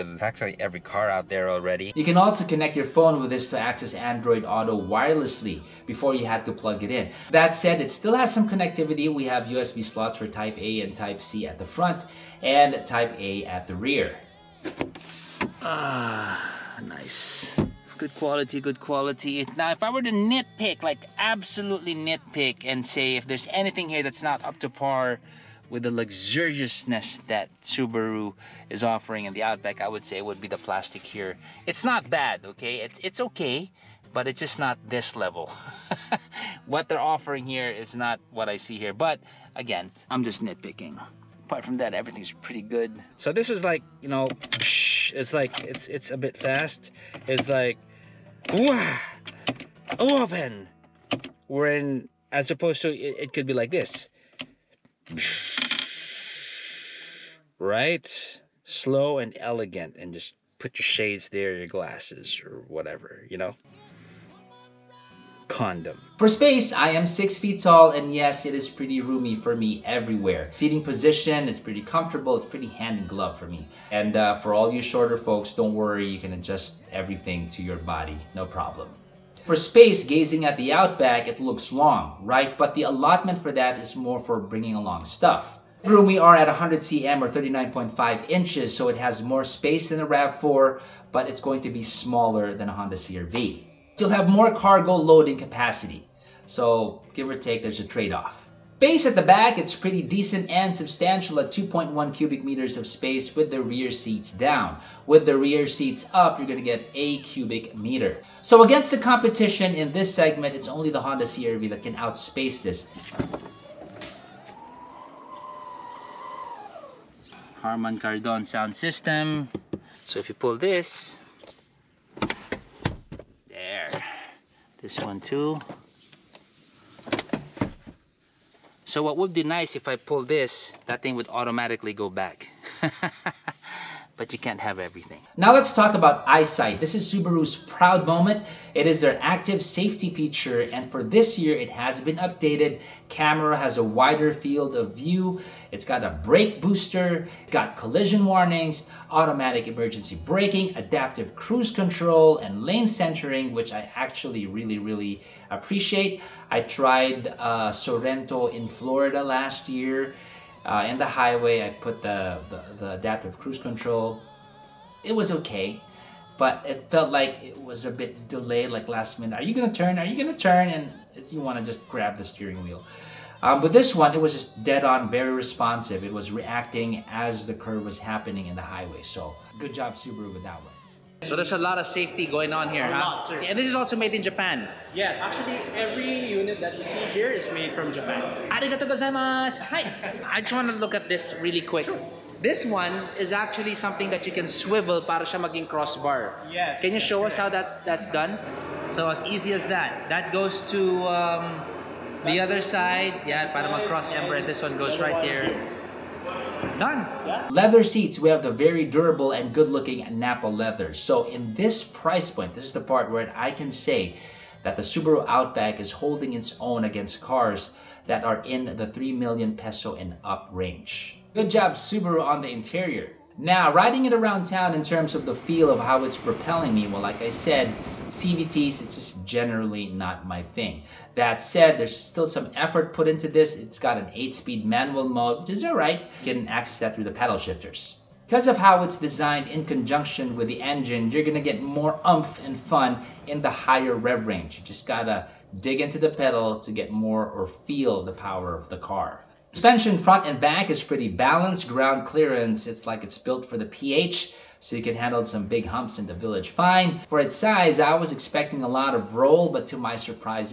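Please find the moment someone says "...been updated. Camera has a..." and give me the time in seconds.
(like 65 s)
142 s.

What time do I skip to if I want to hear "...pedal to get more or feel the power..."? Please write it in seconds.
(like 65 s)
246 s.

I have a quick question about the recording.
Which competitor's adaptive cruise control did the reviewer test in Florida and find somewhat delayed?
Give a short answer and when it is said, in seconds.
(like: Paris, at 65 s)
Sorento, at 157 s.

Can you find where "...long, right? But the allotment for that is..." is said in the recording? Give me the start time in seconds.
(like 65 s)
81 s.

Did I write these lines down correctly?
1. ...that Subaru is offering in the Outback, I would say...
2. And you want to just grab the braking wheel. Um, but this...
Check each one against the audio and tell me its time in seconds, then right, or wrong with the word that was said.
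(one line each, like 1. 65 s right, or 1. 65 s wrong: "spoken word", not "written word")
1. 27 s right
2. 170 s wrong: "steering", not "braking".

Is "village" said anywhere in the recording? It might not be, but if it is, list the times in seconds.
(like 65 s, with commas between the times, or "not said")
256 s.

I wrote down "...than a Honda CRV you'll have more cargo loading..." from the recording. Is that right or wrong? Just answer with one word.
right.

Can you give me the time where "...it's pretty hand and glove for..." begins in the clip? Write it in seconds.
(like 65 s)
72 s.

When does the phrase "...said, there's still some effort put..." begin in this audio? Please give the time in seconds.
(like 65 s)
231 s.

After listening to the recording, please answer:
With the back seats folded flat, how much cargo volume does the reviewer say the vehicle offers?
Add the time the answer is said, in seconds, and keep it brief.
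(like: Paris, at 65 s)
2.1 cubic meters, at 101 s.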